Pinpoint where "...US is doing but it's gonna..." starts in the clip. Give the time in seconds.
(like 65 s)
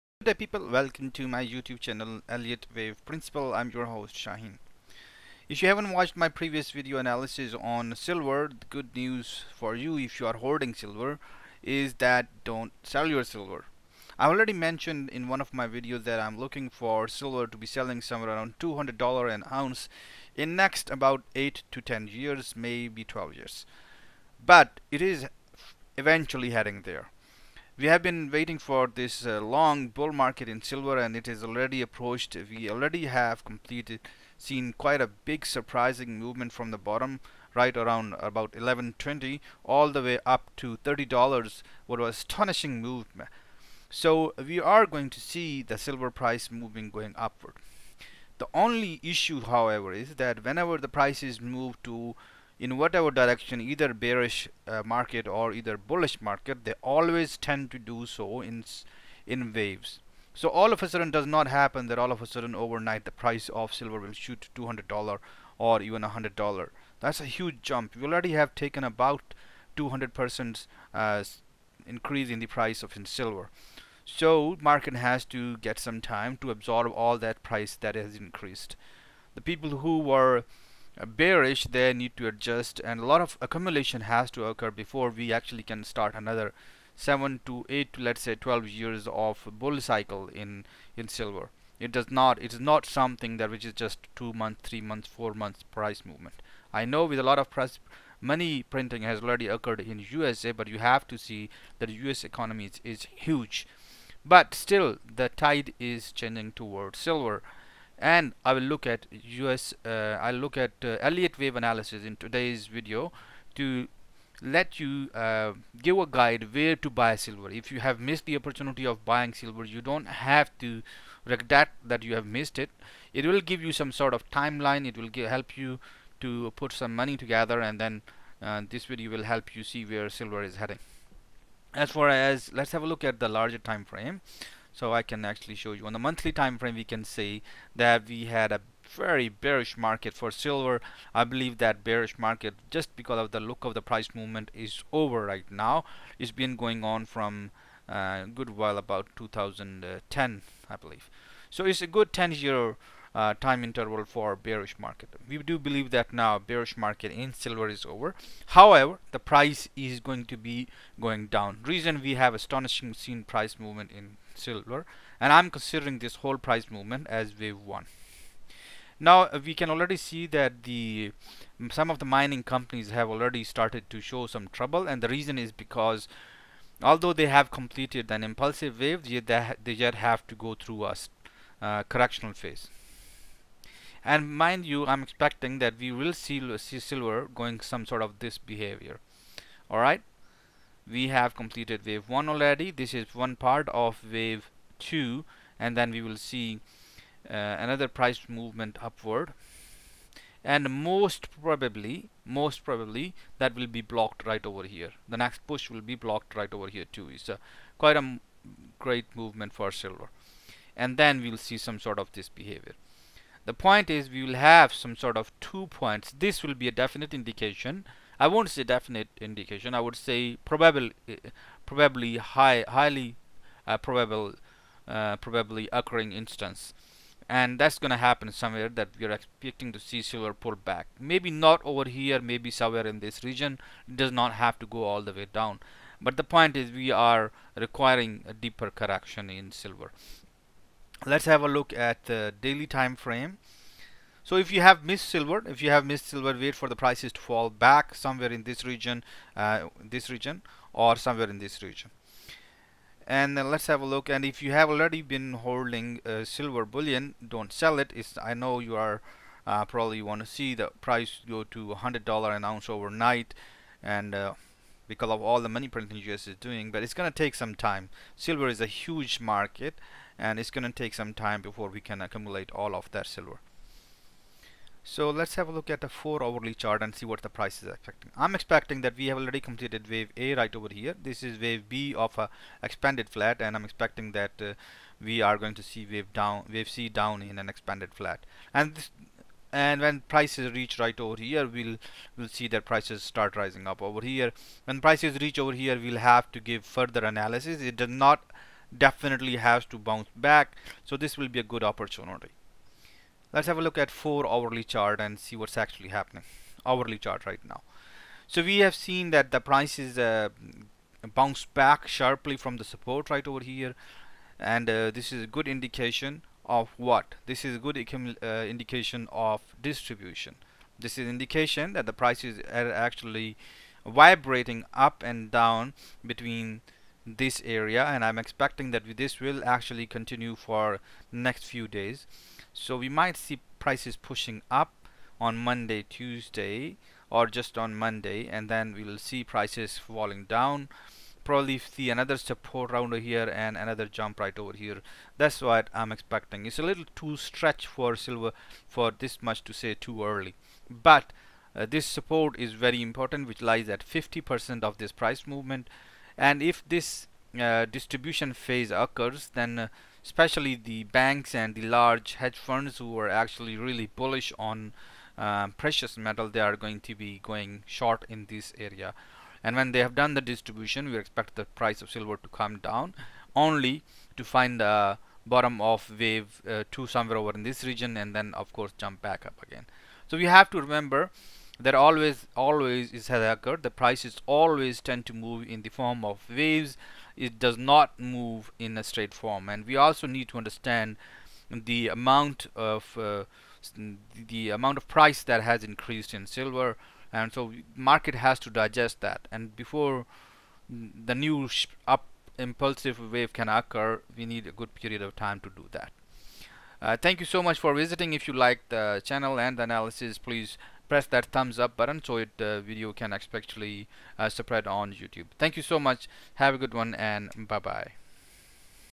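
266 s.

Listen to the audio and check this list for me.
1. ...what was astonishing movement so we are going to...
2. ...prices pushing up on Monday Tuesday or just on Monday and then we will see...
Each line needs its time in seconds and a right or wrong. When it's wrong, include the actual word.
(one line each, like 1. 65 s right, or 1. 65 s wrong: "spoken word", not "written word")
1. 41 s right
2. 333 s right.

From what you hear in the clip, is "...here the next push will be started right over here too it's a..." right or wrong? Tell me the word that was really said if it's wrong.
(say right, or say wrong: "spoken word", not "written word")
wrong: "blocked", not "started".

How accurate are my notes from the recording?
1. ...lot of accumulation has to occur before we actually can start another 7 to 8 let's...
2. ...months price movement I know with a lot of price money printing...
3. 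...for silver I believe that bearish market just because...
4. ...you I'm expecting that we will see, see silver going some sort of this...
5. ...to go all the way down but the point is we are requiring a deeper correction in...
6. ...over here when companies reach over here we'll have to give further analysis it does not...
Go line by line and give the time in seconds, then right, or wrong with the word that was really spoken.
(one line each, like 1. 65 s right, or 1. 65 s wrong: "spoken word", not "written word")
1. 83 s right
2. 95 s right
3. 140 s right
4. 184 s right
5. 234 s right
6. 293 s wrong: "prices", not "companies".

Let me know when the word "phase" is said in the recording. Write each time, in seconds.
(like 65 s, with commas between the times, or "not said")
182 s, 358 s.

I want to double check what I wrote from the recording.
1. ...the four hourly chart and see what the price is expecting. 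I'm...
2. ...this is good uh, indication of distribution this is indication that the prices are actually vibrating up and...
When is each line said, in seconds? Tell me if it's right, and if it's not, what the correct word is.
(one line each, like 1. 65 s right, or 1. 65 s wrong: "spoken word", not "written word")
1. 275 s right
2. 317 s right.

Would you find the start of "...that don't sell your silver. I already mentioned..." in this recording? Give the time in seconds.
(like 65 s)
11 s.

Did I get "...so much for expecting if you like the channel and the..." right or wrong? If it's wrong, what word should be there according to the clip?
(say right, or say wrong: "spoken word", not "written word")
wrong: "visiting", not "expecting".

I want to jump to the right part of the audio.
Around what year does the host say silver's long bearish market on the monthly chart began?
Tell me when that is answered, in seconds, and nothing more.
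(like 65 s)
149 s.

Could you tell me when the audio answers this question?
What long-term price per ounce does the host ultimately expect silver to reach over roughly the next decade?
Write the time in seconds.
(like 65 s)
18 s.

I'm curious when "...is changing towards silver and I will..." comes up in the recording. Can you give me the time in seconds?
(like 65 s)
105 s.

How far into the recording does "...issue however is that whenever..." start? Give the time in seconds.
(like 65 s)
49 s.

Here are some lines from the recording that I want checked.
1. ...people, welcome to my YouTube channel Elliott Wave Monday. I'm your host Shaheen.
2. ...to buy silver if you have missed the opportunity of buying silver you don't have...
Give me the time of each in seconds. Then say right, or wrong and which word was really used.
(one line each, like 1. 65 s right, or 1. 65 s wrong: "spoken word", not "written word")
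1. 0 s wrong: "Principle", not "Monday"
2. 116 s right.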